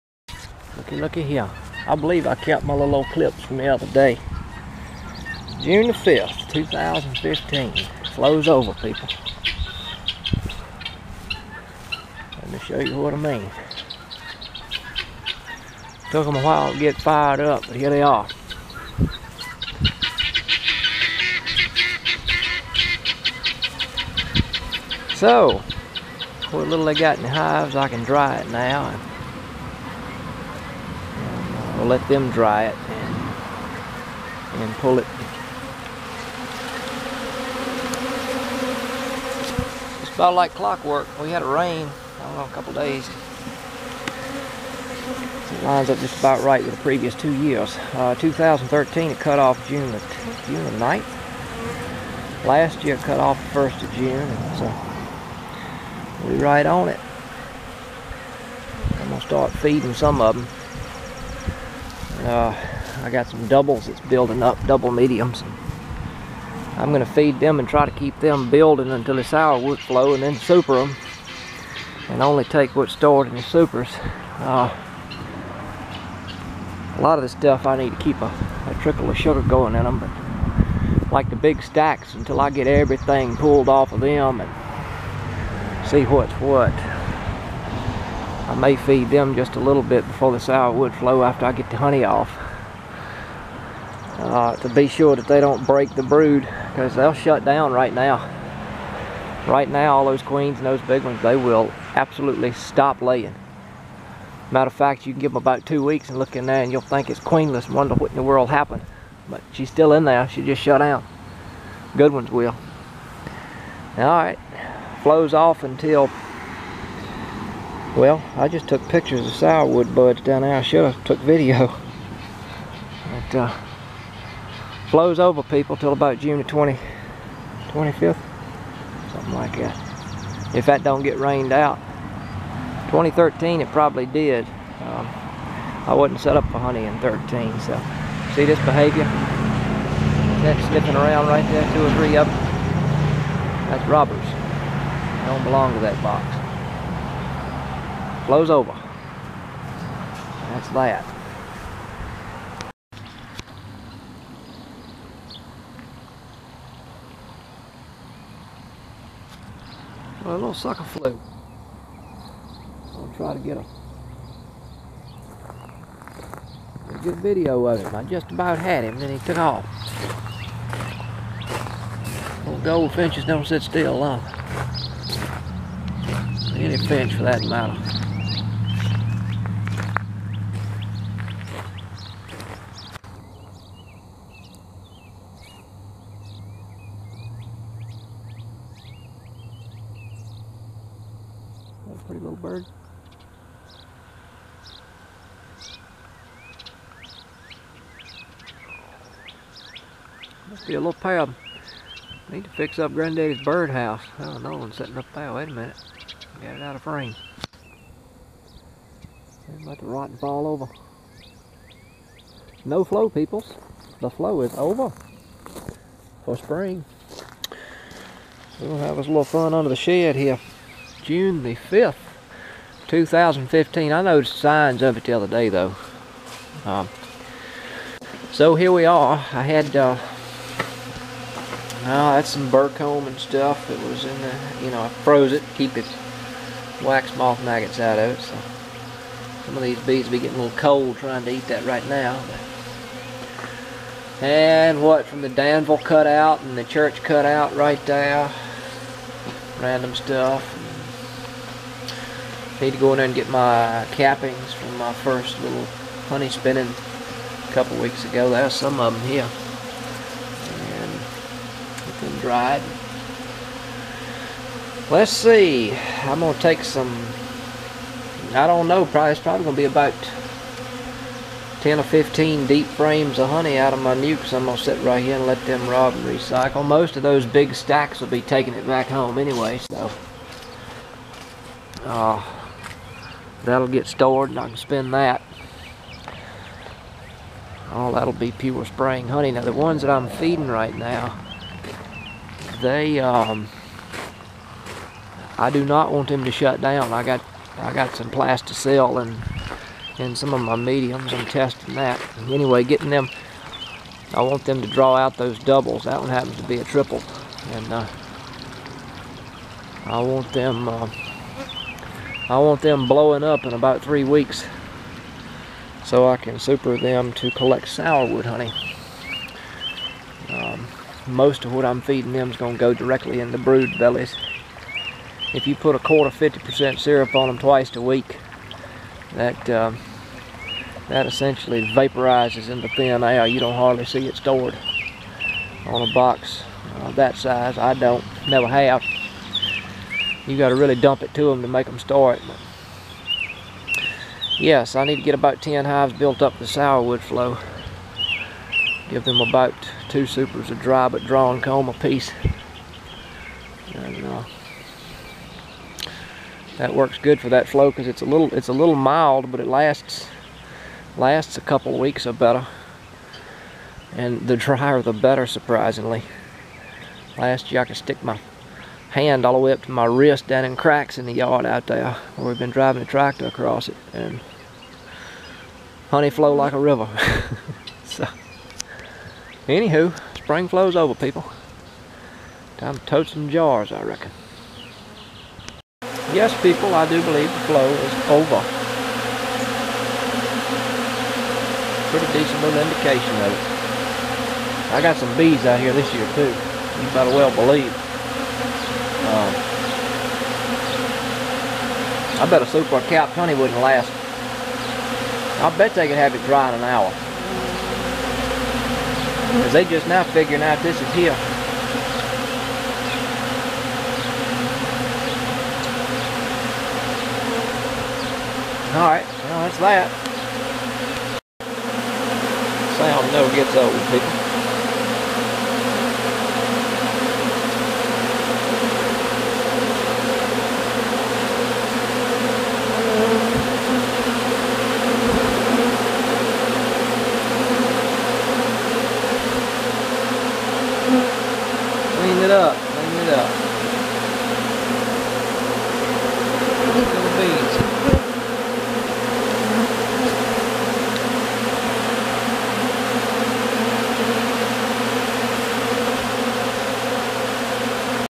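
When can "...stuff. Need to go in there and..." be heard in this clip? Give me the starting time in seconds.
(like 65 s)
249 s.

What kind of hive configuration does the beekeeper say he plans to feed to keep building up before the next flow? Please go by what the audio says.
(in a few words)
double mediums.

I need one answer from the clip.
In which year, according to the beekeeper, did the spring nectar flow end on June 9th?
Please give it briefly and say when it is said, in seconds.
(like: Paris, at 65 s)
2013, at 48 s.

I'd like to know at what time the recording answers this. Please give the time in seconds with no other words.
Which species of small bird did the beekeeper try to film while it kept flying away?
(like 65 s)
172 s.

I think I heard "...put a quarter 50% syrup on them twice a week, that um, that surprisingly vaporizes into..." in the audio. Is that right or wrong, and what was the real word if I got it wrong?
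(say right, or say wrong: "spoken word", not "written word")
wrong: "essentially", not "surprisingly".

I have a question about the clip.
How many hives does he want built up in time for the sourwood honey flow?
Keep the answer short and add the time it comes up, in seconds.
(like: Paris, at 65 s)
10, at 345 s.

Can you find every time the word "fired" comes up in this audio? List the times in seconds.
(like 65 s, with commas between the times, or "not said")
16 s.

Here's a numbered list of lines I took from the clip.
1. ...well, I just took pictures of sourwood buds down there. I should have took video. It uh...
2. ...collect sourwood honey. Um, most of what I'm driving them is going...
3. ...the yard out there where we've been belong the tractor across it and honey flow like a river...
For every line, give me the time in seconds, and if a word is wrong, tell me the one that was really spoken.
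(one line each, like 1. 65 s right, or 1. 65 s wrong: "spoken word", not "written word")
1. 117 s right
2. 317 s wrong: "feeding", not "driving"
3. 371 s wrong: "driving", not "belong".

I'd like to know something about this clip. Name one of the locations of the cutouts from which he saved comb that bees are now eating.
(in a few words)
Danville.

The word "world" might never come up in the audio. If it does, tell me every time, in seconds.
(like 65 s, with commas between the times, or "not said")
108 s.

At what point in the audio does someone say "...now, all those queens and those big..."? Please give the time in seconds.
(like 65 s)
99 s.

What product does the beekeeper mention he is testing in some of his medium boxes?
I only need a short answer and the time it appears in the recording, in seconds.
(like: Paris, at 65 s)
Plasticell, at 298 s.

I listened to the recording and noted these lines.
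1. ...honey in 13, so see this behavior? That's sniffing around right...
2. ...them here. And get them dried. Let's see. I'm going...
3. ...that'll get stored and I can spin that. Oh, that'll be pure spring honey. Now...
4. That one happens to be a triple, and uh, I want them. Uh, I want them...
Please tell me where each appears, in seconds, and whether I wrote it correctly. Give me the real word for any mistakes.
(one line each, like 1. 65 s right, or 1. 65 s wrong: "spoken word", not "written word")
1. 136 s right
2. 258 s right
3. 283 s right
4. 305 s right.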